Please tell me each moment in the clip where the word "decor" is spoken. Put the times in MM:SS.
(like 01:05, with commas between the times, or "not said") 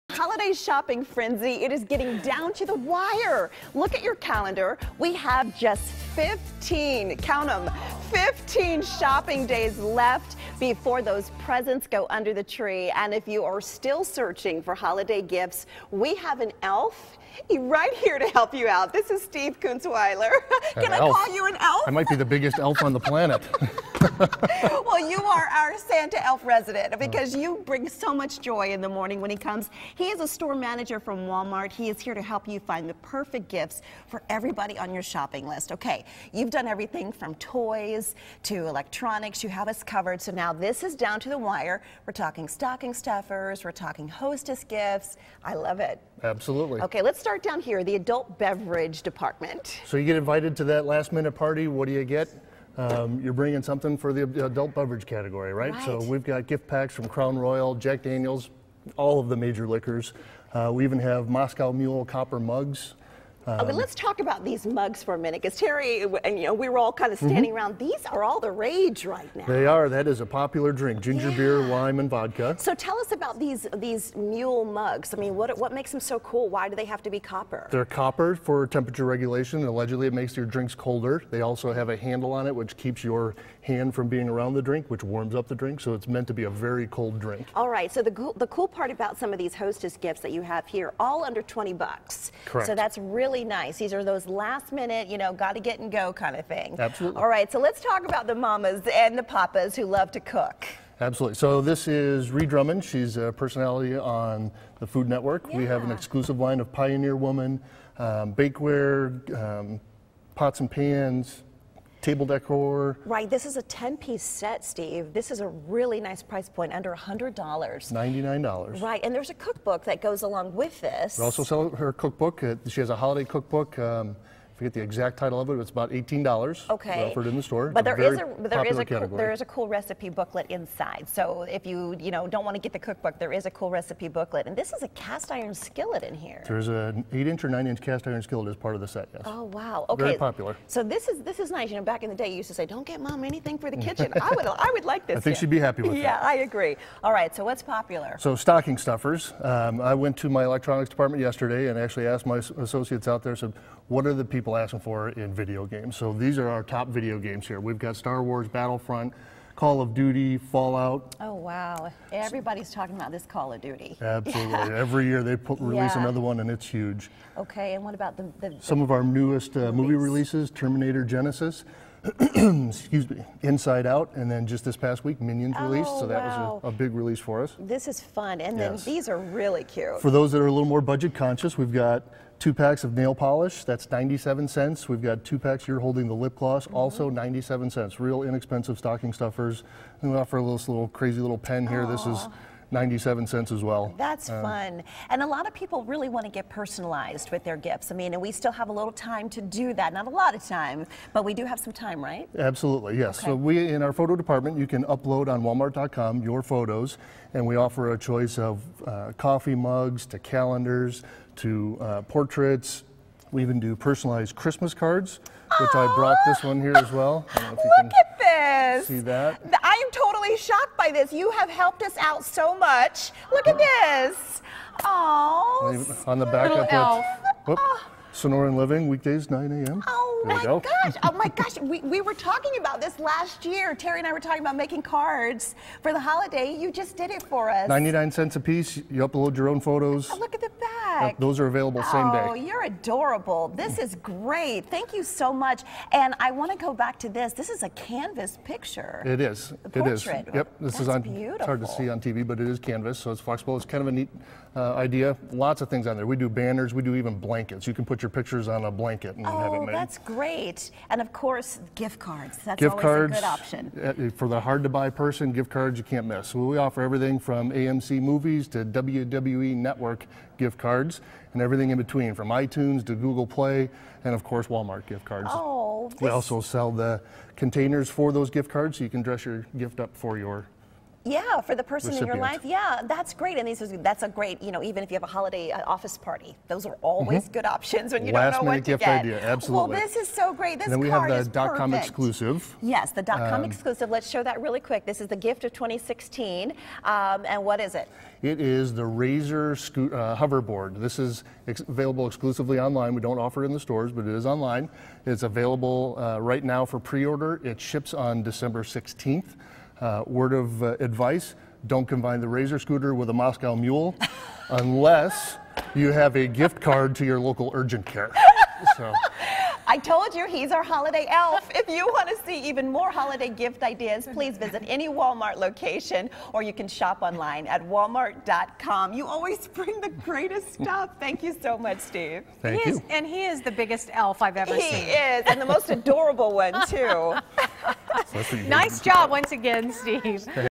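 01:52.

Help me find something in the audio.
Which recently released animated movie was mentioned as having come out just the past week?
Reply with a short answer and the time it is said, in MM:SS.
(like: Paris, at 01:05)
Minions, at 02:55.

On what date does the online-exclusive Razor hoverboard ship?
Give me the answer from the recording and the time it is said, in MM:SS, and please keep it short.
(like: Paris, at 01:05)
December 16, at 05:08.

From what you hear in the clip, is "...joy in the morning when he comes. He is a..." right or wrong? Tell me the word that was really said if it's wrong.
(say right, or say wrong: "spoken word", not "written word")
right.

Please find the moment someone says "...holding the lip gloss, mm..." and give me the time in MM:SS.
03:05.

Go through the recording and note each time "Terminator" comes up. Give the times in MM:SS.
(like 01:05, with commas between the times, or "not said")
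02:50.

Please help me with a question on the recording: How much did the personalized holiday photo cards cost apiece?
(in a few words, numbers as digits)
99 cents.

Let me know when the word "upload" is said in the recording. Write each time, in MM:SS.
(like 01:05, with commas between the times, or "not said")
03:24, 03:59.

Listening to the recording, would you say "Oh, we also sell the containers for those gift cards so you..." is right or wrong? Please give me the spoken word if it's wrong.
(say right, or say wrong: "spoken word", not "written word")
right.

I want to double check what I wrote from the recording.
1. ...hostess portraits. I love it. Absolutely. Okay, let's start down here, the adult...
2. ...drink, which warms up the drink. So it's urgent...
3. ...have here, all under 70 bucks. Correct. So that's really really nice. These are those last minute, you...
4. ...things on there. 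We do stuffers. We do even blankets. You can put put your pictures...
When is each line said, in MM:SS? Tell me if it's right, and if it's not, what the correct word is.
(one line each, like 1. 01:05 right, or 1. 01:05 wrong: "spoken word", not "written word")
1. 00:44 wrong: "gifts", not "portraits"
2. 01:24 wrong: "meant", not "urgent"
3. 01:30 wrong: "20", not "70"
4. 04:15 wrong: "banners", not "stuffers".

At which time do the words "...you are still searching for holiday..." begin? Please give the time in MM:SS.
00:13.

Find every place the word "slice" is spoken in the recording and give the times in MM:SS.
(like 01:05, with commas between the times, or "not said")
not said.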